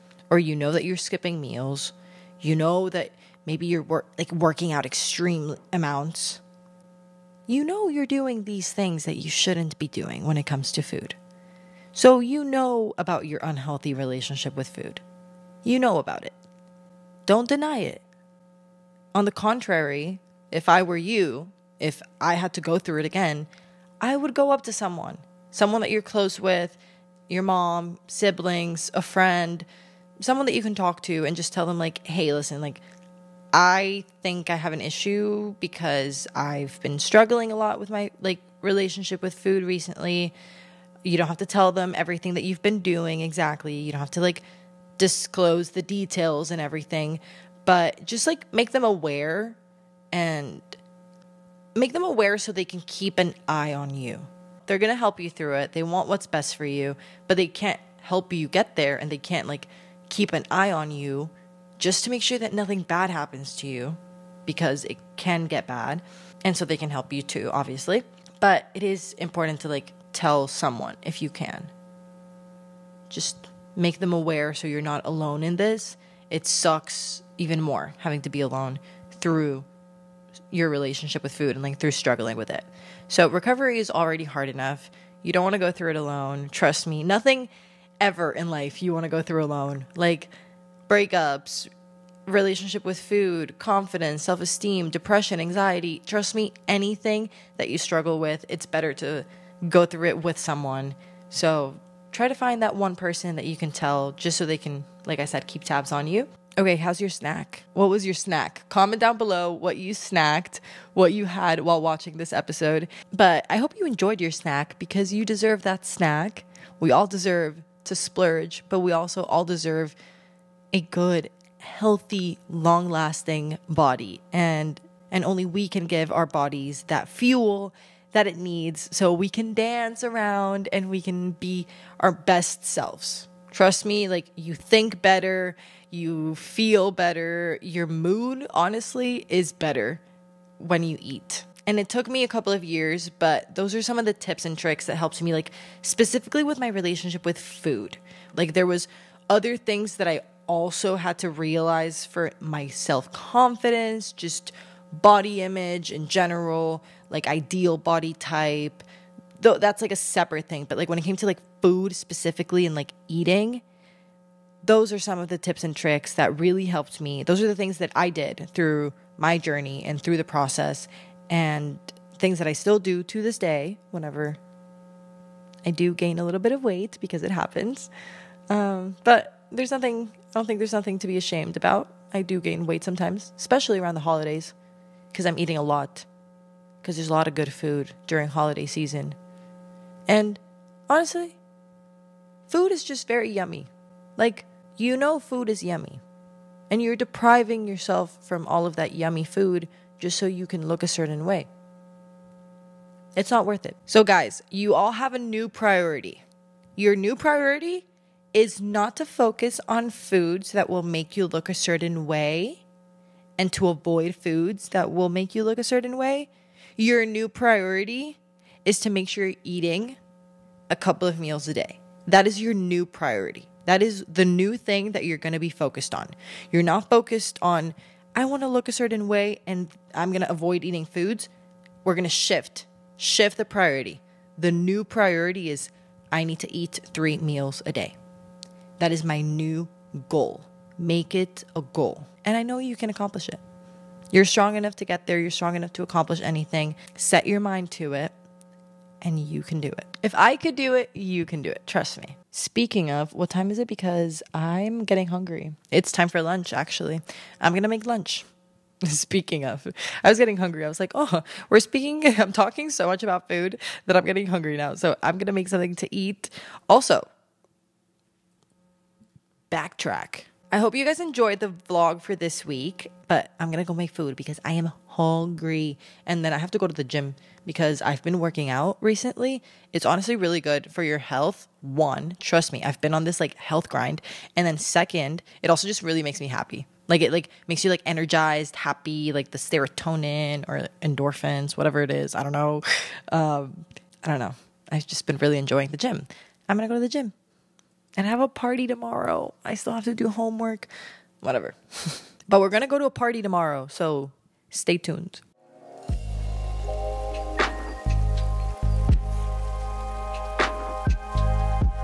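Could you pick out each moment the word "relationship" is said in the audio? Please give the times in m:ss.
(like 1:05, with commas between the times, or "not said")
0:13, 0:38, 1:20, 1:32, 2:26.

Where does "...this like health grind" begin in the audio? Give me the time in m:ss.
4:43.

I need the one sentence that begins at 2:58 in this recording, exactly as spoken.
Um, but there's nothing, I don't think there's nothing to be ashamed about.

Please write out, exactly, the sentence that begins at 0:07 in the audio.
You know you're doing these things that you shouldn't be doing when it comes to food.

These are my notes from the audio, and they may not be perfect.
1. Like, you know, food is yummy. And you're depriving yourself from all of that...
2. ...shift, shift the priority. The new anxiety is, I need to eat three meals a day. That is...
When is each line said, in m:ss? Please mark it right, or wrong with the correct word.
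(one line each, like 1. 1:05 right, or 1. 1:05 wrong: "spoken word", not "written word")
1. 3:14 right
2. 3:52 wrong: "priority", not "anxiety".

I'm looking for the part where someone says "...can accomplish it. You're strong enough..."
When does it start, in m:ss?
4:02.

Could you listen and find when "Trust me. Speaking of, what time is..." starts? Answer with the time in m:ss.
4:11.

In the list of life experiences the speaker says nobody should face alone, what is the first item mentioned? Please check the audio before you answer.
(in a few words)
Breakups.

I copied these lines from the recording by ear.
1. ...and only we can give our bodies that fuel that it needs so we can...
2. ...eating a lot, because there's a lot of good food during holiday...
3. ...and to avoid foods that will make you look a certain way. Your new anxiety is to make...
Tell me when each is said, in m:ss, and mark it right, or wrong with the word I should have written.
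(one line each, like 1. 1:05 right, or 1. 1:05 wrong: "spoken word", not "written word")
1. 2:05 right
2. 3:05 right
3. 3:33 wrong: "priority", not "anxiety".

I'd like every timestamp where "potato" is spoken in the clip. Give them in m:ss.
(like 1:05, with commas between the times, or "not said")
not said.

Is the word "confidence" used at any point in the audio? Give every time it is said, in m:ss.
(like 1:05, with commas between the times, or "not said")
1:33, 2:33.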